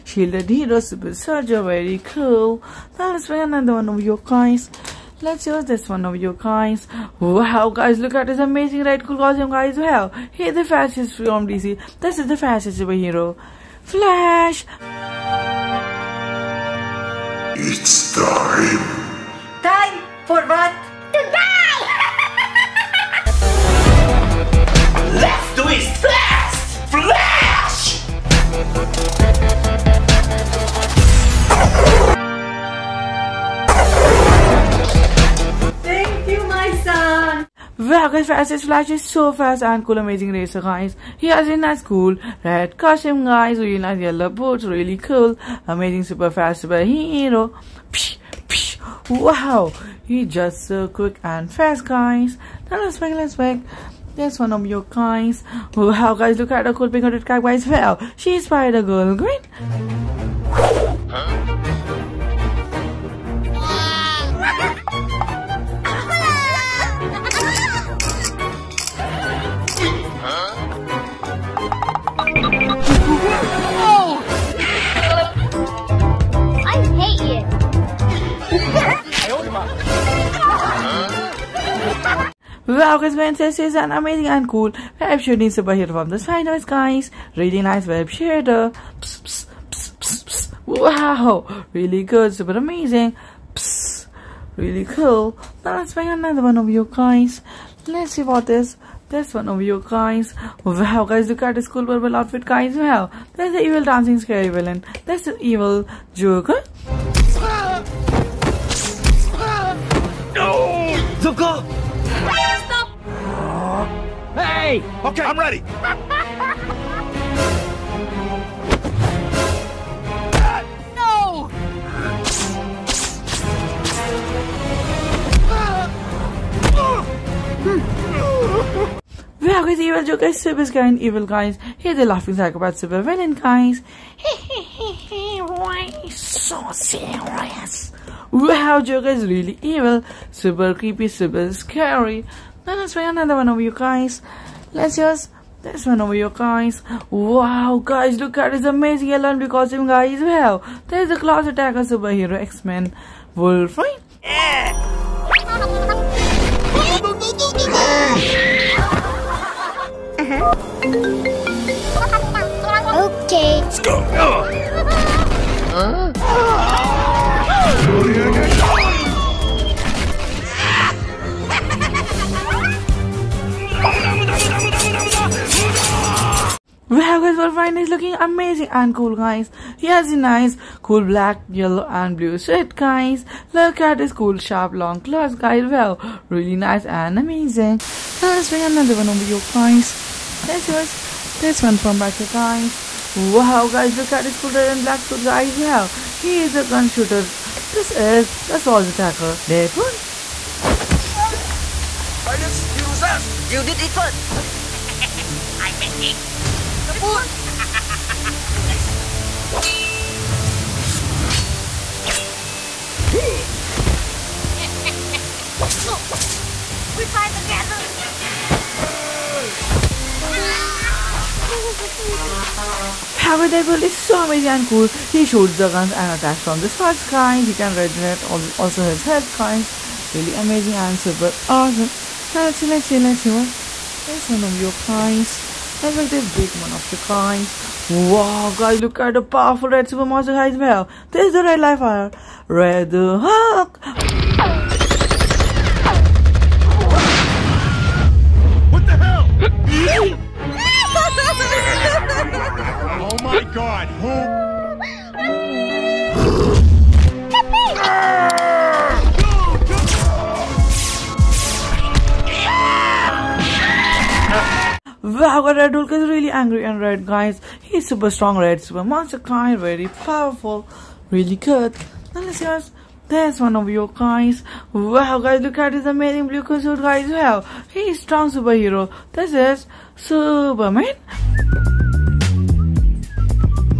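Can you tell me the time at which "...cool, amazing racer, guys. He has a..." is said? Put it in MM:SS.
00:39.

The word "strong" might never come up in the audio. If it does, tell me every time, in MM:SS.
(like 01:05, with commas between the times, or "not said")
04:28, 04:37.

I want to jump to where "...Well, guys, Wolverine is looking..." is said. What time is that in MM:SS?
02:56.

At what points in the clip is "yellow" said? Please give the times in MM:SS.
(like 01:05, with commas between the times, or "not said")
00:43, 03:01.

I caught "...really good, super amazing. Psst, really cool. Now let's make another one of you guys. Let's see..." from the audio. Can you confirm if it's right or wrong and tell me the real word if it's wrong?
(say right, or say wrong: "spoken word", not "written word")
right.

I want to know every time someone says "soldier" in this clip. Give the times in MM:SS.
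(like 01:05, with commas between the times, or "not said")
00:01, 03:18.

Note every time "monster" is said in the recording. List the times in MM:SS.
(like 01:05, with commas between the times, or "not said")
04:00, 04:28.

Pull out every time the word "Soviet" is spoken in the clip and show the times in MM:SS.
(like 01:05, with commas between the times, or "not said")
not said.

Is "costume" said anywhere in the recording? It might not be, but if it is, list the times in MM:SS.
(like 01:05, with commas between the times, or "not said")
00:09, 00:42, 02:29, 04:36.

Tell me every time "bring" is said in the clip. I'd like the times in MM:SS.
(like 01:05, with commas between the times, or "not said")
00:03, 03:08.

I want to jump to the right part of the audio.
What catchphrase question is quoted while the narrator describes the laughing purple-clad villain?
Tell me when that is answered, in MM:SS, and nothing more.
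02:15.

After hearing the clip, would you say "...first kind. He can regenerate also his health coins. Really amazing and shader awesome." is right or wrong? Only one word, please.
wrong.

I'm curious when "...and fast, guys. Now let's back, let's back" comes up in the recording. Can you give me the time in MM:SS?
00:51.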